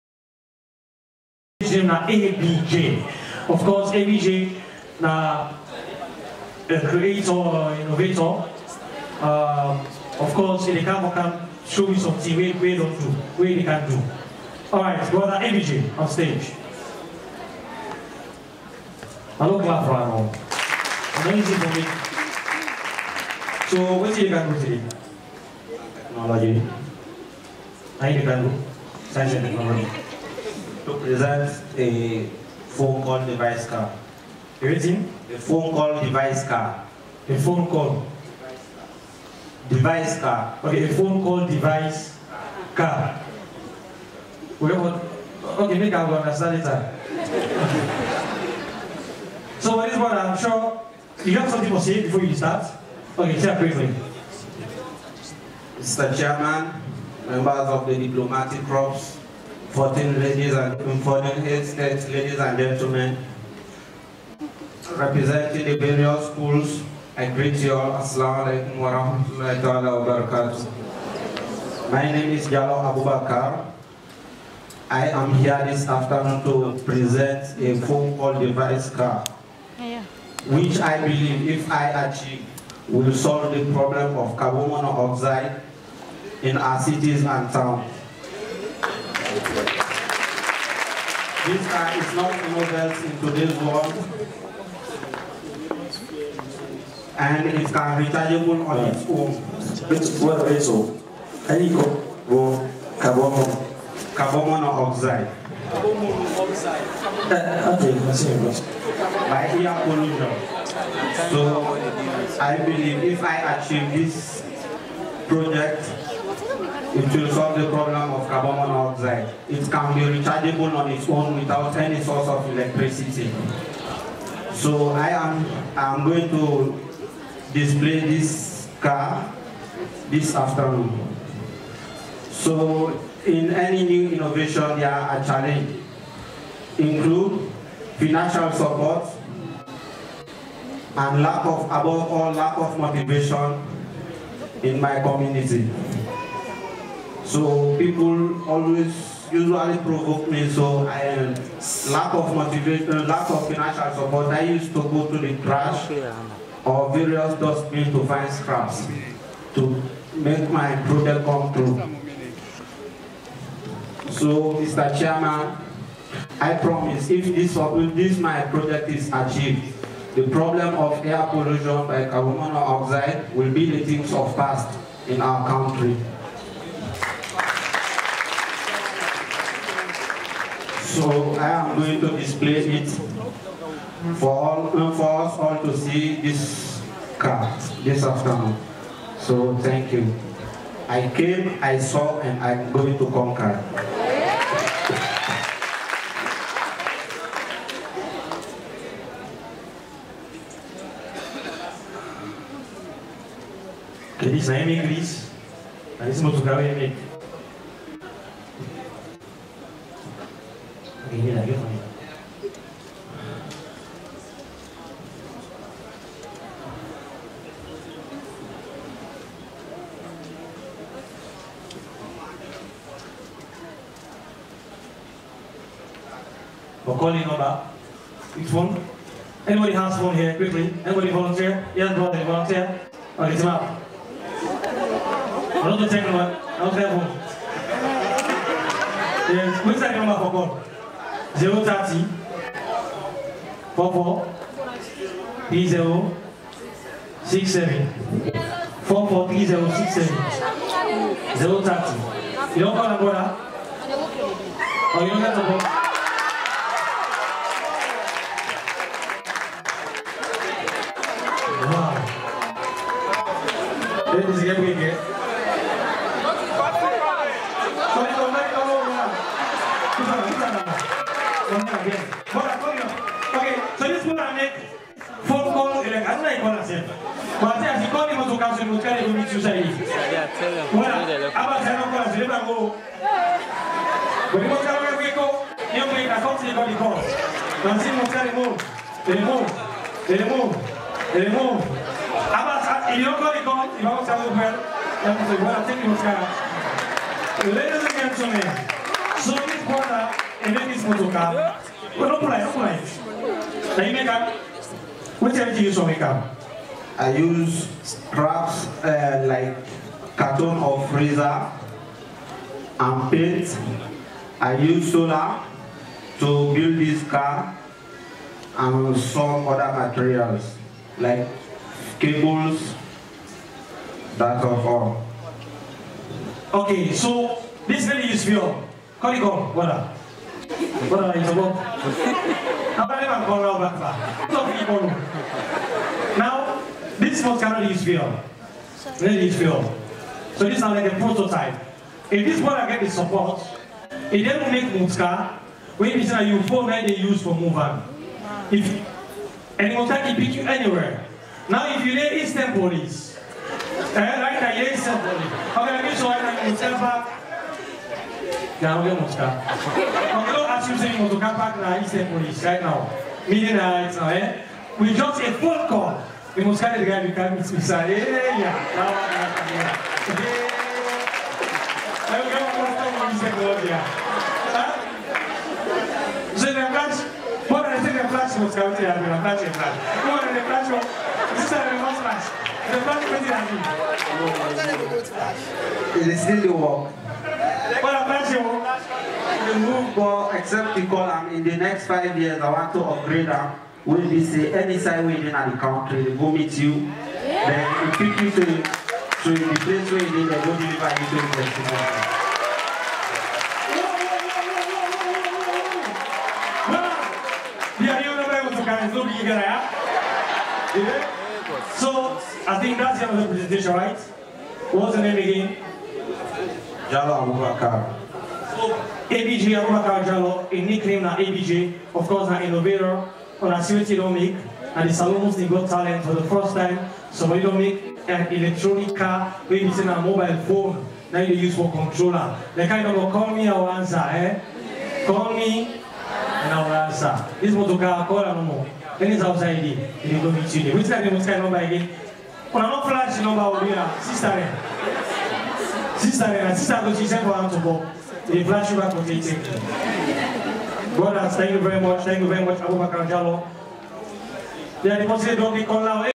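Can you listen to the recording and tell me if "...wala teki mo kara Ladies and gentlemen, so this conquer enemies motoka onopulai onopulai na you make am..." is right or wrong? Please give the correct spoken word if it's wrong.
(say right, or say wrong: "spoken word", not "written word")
wrong: "brother", not "conquer".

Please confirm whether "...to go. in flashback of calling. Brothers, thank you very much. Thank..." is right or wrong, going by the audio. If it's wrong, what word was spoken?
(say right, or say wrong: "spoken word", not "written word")
wrong: "meeting", not "calling".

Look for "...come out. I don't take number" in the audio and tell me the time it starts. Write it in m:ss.
3:53.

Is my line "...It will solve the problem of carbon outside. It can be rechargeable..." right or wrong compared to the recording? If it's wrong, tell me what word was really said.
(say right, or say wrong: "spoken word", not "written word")
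wrong: "monoxide", not "outside".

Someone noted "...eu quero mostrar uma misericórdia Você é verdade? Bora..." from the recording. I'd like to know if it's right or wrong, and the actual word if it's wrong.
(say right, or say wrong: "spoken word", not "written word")
right.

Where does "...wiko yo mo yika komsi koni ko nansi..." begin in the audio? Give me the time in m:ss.
4:45.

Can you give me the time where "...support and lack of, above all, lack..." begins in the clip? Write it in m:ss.
2:18.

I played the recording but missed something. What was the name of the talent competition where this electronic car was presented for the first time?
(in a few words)
Salon Muslim Got Talent.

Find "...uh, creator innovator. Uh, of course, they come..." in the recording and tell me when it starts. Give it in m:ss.
0:06.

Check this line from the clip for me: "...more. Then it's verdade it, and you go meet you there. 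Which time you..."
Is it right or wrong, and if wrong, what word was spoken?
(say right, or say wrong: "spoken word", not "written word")
wrong: "outside", not "verdade".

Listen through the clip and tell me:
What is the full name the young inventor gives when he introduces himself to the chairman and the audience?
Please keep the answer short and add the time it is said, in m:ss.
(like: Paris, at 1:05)
Jalloh Abubakar, at 1:12.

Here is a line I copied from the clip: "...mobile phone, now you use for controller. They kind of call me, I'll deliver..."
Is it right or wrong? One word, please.
wrong.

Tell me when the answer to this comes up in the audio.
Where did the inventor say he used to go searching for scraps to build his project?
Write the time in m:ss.
2:35.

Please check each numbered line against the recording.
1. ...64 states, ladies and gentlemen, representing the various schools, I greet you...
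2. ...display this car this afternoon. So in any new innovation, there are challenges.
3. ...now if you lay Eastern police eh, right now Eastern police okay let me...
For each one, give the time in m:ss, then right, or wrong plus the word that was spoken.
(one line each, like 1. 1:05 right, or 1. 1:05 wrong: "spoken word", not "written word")
1. 1:01 wrong: "14", not "64"
2. 2:07 right
3. 5:51 right.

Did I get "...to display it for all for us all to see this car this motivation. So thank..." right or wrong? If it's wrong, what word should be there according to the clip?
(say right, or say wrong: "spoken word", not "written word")
wrong: "afternoon", not "motivation".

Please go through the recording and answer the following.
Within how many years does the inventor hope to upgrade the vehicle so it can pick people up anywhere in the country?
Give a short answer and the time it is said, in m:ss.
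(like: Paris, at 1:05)
5, at 6:31.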